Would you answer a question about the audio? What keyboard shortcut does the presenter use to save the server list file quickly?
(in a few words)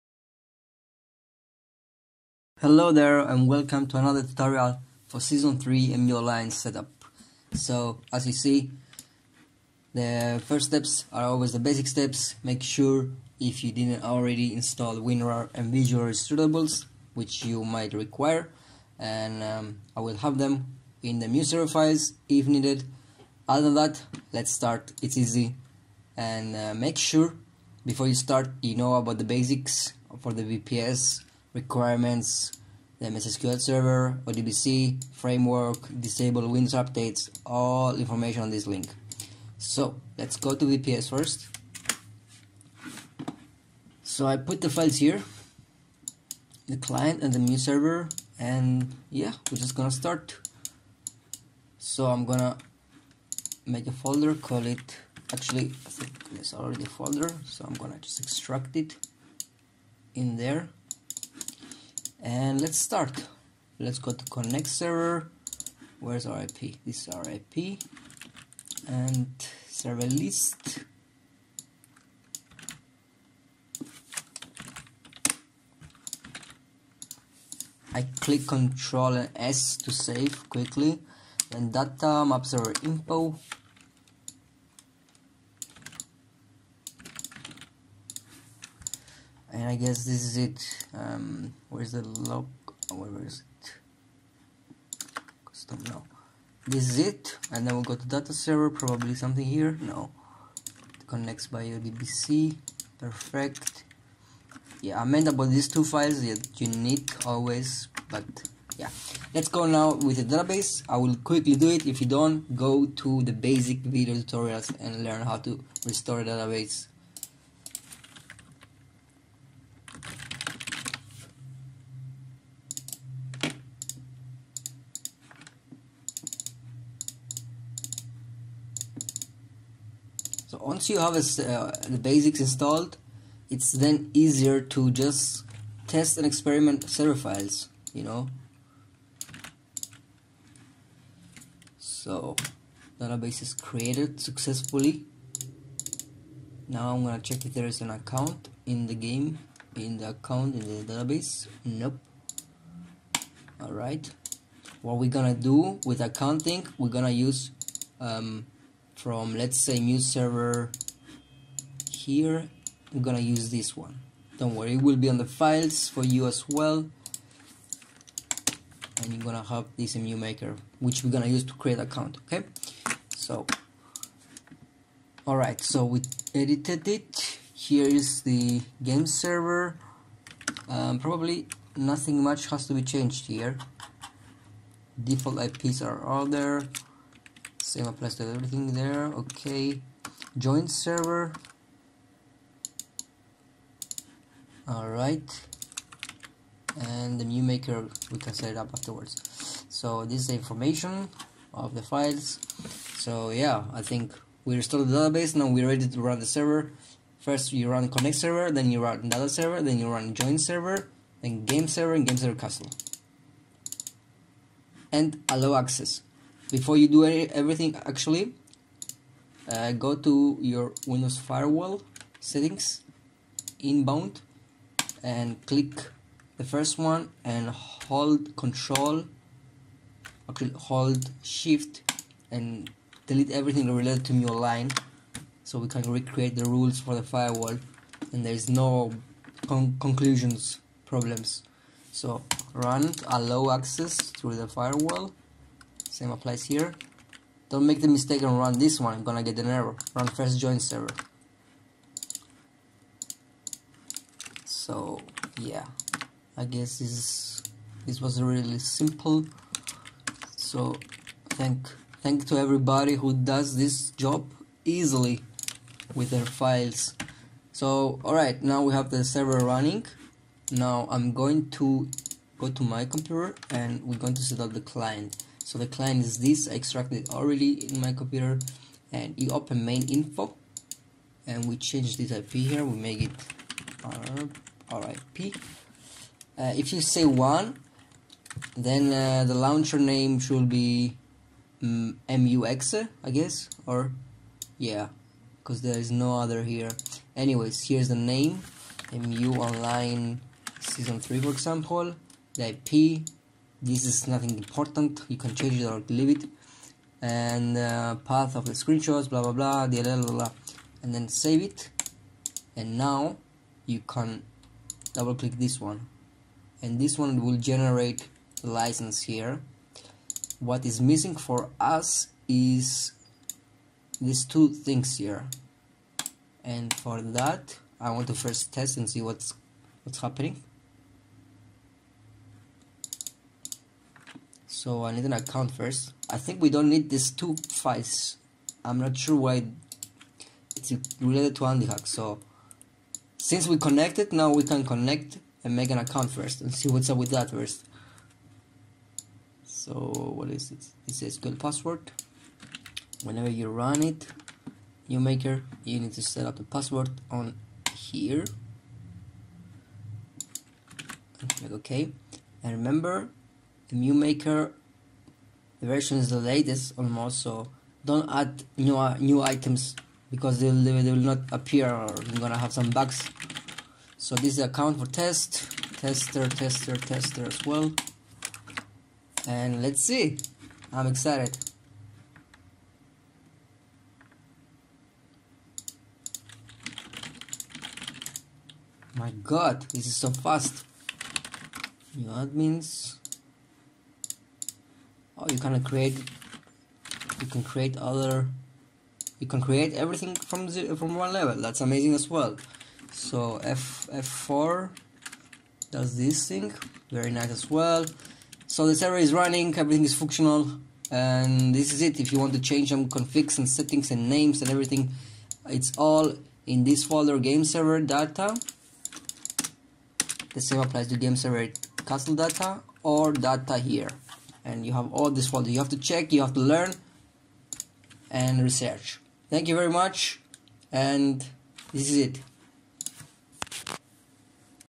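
Control S.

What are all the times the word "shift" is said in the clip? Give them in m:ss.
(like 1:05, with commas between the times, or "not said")
3:51.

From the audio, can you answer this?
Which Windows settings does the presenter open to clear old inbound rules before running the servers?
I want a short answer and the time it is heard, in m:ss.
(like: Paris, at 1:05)
Windows firewall, at 3:40.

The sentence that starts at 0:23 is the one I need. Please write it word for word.
Other than that, let's start, it's easy.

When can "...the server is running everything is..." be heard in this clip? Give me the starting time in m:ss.
6:48.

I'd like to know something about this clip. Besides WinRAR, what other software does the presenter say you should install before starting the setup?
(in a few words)
Visual Redistributables.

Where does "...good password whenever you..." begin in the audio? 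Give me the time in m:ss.
5:51.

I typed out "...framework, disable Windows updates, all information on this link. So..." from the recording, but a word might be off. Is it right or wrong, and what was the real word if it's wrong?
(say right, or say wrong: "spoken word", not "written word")
right.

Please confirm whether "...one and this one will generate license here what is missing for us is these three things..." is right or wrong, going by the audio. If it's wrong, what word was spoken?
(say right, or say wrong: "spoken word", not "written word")
wrong: "two", not "three".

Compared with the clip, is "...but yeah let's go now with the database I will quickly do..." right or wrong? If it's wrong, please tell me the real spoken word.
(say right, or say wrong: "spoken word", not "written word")
right.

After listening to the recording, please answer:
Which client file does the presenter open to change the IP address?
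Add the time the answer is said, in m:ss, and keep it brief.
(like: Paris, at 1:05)
main info, at 4:39.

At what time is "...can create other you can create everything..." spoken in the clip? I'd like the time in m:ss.
6:37.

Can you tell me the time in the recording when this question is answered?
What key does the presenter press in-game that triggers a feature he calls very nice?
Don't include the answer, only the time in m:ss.
6:43.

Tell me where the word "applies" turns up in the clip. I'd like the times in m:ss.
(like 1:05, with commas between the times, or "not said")
3:07, 4:06, 7:00.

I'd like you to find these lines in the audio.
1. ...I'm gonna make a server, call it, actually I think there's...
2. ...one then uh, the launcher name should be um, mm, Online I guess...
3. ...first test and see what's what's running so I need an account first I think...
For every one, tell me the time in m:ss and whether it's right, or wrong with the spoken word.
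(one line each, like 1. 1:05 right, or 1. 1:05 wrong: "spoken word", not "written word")
1. 0:52 wrong: "folder", not "server"
2. 4:47 wrong: "MUX", not "Online"
3. 5:28 wrong: "happening", not "running".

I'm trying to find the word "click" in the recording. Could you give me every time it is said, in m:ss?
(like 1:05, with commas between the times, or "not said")
1:18, 3:45, 5:15, 6:01.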